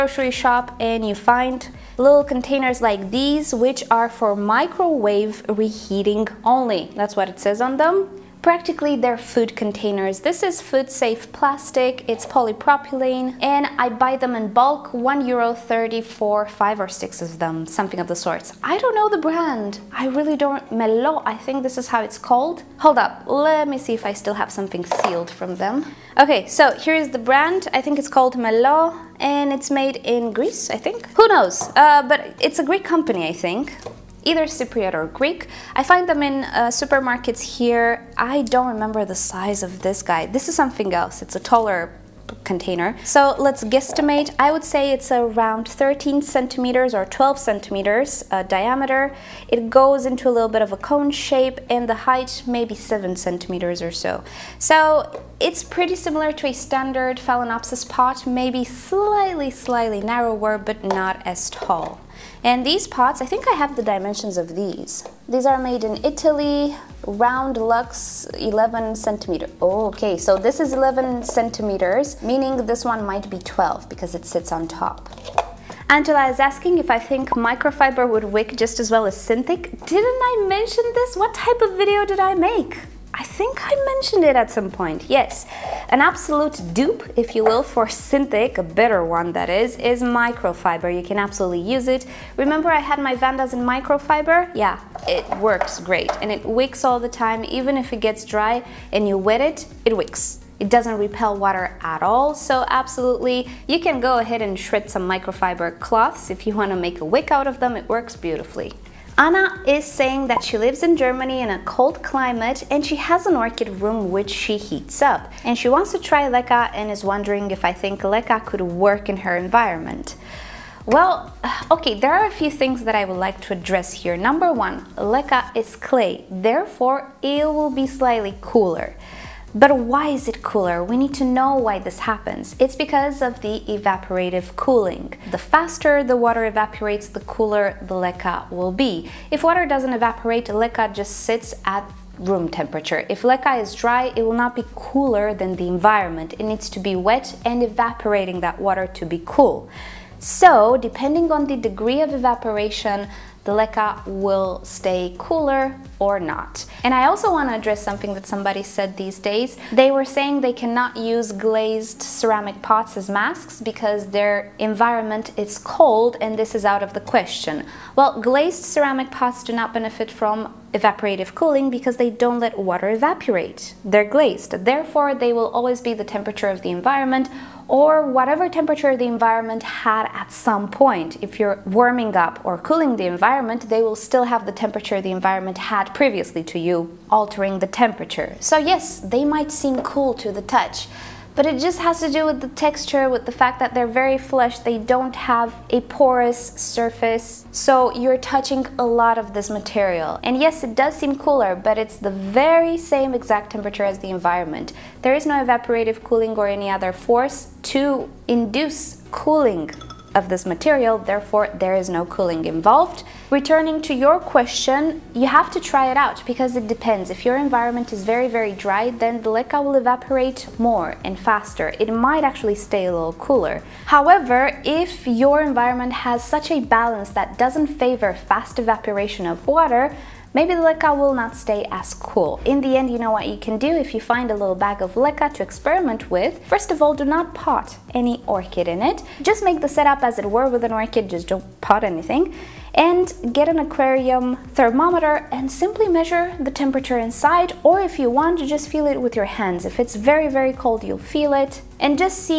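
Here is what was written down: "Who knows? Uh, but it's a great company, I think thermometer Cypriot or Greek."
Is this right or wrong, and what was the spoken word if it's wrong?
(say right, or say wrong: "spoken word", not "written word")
wrong: "either", not "thermometer".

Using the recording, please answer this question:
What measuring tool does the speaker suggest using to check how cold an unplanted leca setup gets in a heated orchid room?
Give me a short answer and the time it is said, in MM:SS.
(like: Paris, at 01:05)
aquarium thermometer, at 04:03.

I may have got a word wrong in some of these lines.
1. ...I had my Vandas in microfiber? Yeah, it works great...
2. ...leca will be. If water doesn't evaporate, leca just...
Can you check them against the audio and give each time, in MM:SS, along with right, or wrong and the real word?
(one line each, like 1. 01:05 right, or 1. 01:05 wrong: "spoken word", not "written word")
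1. 01:32 right
2. 02:17 right.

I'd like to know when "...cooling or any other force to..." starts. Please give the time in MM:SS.
03:26.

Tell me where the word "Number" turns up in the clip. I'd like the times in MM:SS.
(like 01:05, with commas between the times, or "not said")
02:04.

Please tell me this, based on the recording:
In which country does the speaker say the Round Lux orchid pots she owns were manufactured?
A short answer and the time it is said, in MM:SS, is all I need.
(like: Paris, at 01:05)
Italy, at 01:06.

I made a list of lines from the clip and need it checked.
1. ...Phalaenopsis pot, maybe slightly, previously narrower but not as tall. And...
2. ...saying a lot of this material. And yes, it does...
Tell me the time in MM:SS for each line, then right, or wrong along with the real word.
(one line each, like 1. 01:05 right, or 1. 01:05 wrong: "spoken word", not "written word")
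1. 00:57 wrong: "slightly", not "previously"
2. 03:18 wrong: "touching", not "saying".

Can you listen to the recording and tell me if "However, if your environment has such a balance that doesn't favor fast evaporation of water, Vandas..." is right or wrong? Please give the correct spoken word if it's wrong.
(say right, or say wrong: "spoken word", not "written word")
wrong: "Maybe", not "Vandas".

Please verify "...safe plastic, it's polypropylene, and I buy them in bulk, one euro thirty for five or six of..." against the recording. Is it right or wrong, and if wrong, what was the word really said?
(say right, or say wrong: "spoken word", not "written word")
right.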